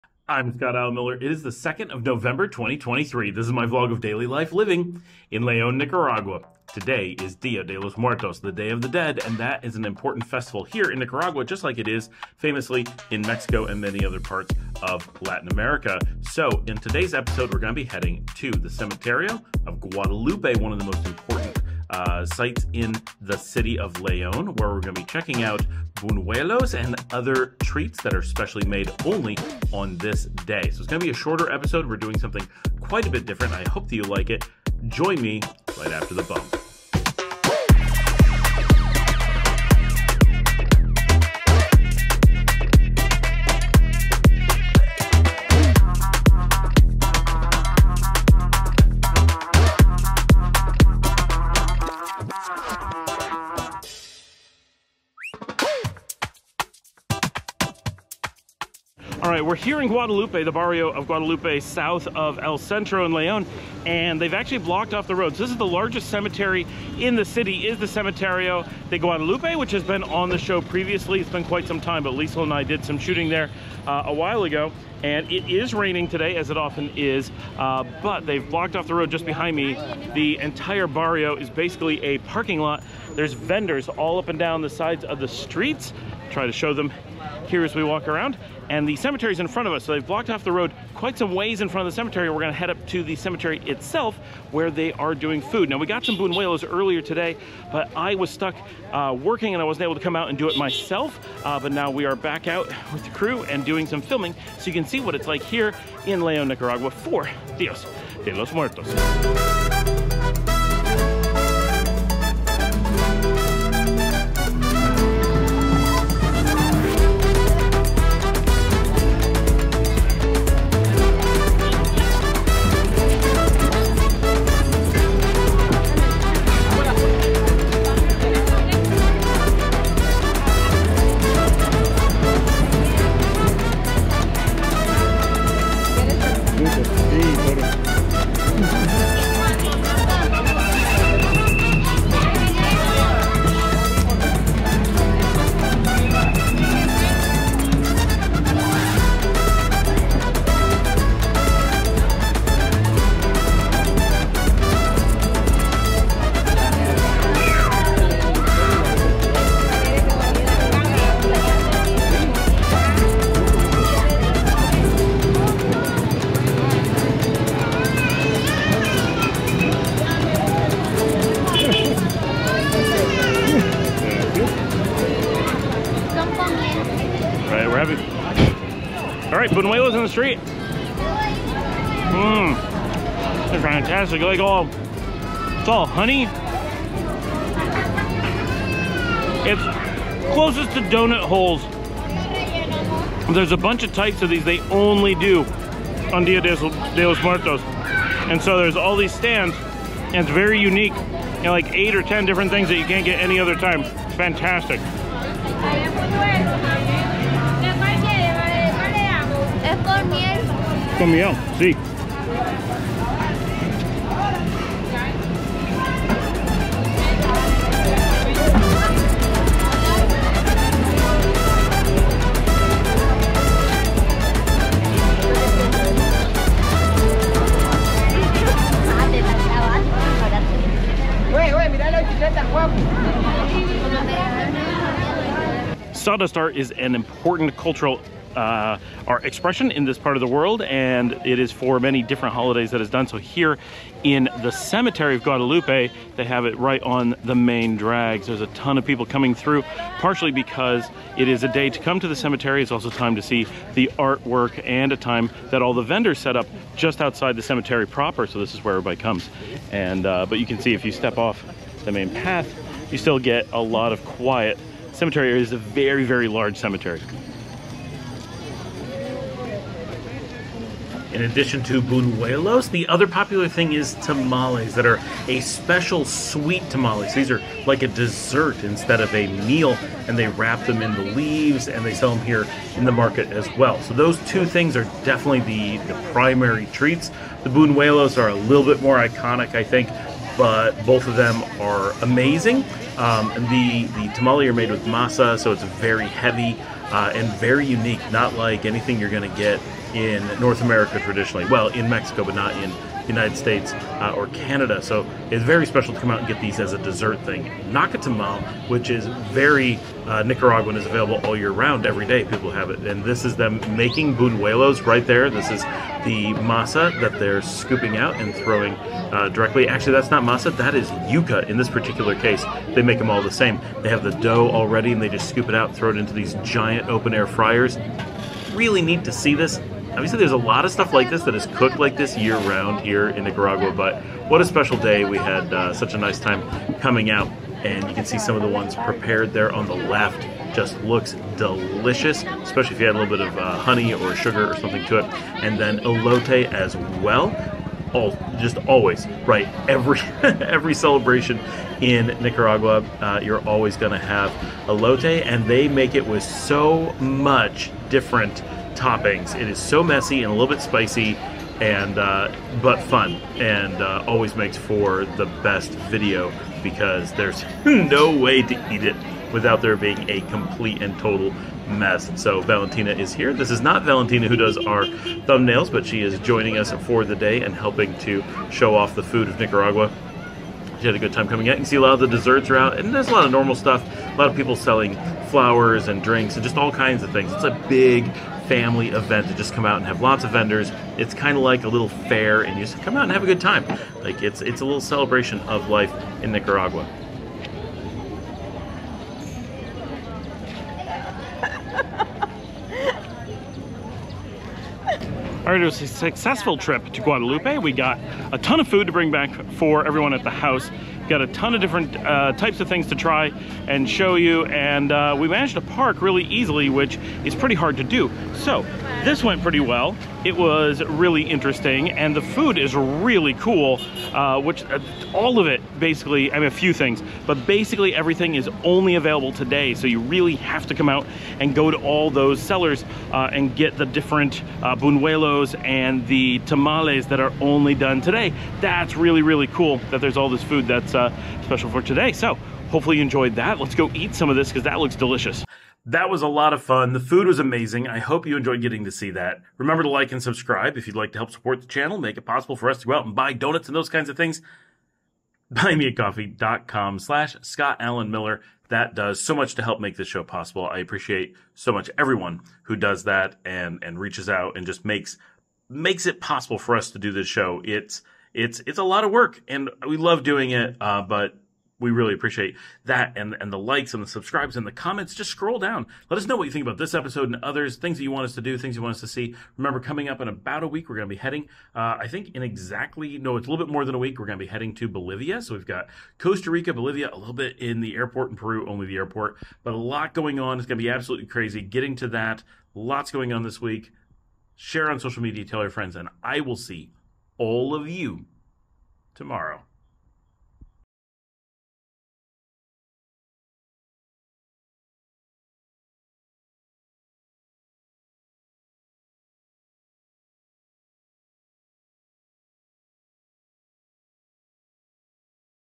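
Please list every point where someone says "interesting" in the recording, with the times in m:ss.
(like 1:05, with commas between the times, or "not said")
7:01.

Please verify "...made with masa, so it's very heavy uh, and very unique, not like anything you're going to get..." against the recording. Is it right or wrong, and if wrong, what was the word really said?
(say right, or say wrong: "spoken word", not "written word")
right.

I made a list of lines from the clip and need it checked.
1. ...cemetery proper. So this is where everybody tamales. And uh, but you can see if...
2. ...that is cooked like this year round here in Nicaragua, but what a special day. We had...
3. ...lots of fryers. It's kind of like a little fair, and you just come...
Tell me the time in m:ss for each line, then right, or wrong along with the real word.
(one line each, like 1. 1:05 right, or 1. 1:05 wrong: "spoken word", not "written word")
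1. 4:17 wrong: "comes", not "tamales"
2. 5:31 right
3. 6:30 wrong: "vendors", not "fryers".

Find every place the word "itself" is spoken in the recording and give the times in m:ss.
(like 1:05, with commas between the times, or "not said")
1:33.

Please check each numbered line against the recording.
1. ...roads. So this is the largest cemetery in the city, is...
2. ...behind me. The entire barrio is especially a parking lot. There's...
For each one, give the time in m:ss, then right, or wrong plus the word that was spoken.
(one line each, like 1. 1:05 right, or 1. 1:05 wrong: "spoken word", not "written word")
1. 1:05 right
2. 1:19 wrong: "basically", not "especially".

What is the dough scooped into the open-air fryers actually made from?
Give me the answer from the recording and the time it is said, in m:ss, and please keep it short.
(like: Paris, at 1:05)
Yuca, at 5:21.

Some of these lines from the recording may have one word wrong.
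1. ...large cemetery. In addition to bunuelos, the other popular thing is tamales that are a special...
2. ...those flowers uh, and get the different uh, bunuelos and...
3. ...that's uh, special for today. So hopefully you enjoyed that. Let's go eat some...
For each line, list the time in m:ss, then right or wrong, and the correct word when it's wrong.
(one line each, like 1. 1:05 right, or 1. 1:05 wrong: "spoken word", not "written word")
1. 4:26 right
2. 7:12 wrong: "sellers", not "flowers"
3. 7:20 right.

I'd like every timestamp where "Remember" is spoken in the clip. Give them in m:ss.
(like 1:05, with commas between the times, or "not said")
7:29, 7:59.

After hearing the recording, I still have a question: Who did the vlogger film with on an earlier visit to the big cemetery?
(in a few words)
Liesl.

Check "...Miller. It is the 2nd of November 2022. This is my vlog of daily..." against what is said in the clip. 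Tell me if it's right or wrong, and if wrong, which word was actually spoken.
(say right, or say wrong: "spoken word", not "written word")
wrong: "2023", not "2022".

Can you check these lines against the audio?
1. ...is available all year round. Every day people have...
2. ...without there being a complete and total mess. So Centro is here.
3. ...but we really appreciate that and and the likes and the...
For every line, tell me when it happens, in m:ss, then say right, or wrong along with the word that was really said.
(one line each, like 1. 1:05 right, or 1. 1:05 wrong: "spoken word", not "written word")
1. 5:10 right
2. 6:09 wrong: "Valentina", not "Centro"
3. 7:51 right.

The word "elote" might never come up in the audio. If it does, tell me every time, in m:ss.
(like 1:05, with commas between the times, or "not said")
5:45, 5:54.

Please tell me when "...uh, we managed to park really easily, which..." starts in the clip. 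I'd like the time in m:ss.
6:54.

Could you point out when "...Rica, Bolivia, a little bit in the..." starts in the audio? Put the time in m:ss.
8:06.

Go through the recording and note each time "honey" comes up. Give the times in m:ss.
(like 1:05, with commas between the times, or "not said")
3:05, 5:43.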